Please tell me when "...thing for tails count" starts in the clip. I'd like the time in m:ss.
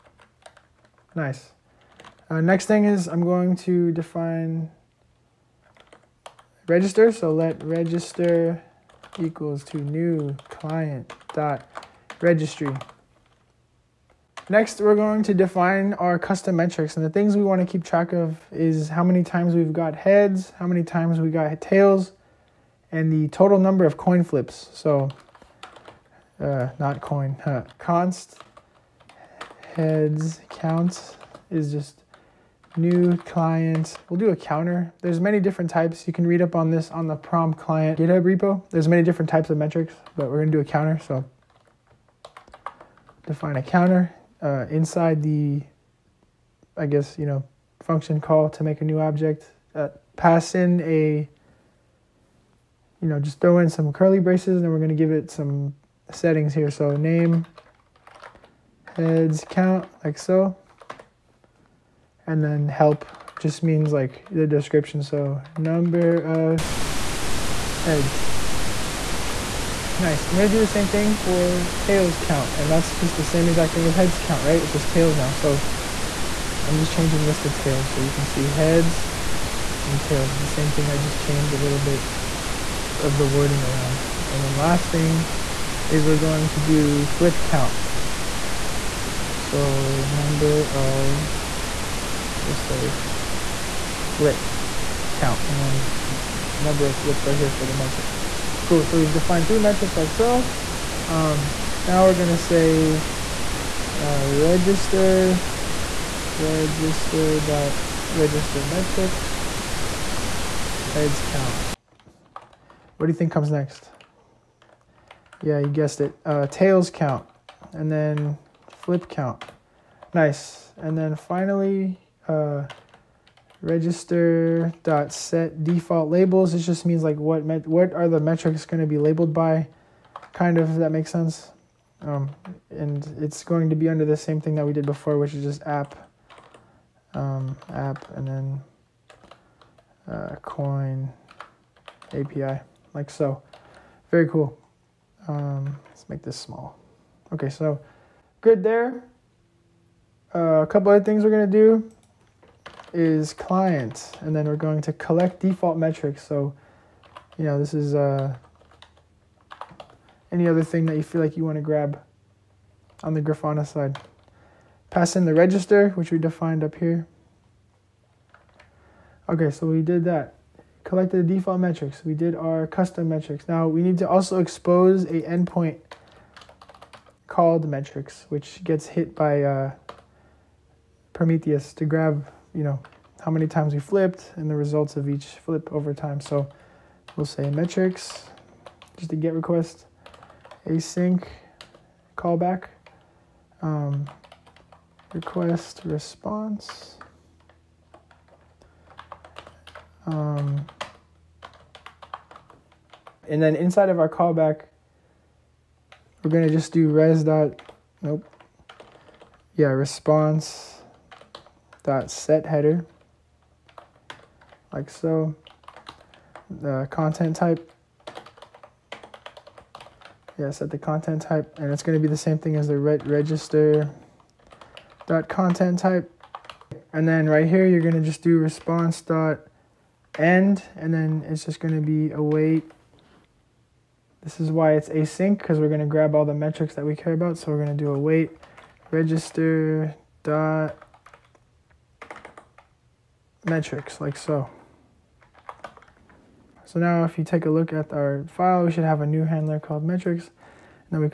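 1:10.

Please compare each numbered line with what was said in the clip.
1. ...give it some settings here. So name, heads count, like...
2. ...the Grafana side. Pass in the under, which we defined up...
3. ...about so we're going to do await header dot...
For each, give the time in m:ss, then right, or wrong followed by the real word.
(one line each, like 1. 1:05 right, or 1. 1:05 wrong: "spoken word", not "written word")
1. 0:54 right
2. 2:43 wrong: "register", not "under"
3. 3:57 wrong: "register", not "header".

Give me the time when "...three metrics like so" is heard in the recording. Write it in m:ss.
1:39.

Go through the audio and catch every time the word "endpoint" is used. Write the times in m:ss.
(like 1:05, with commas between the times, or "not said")
2:55.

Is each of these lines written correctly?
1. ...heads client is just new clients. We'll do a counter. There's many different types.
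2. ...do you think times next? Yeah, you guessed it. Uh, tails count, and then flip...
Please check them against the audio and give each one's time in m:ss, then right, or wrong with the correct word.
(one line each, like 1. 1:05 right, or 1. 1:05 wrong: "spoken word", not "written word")
1. 0:29 wrong: "count", not "client"
2. 1:53 wrong: "comes", not "times".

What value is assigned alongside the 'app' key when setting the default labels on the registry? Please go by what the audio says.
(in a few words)
coin API.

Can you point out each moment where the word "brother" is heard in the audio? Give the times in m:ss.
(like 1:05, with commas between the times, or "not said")
not said.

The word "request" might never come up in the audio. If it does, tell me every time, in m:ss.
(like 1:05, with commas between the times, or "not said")
3:09, 3:15.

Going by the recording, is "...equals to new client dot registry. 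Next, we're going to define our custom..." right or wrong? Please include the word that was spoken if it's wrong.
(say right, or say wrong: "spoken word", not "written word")
right.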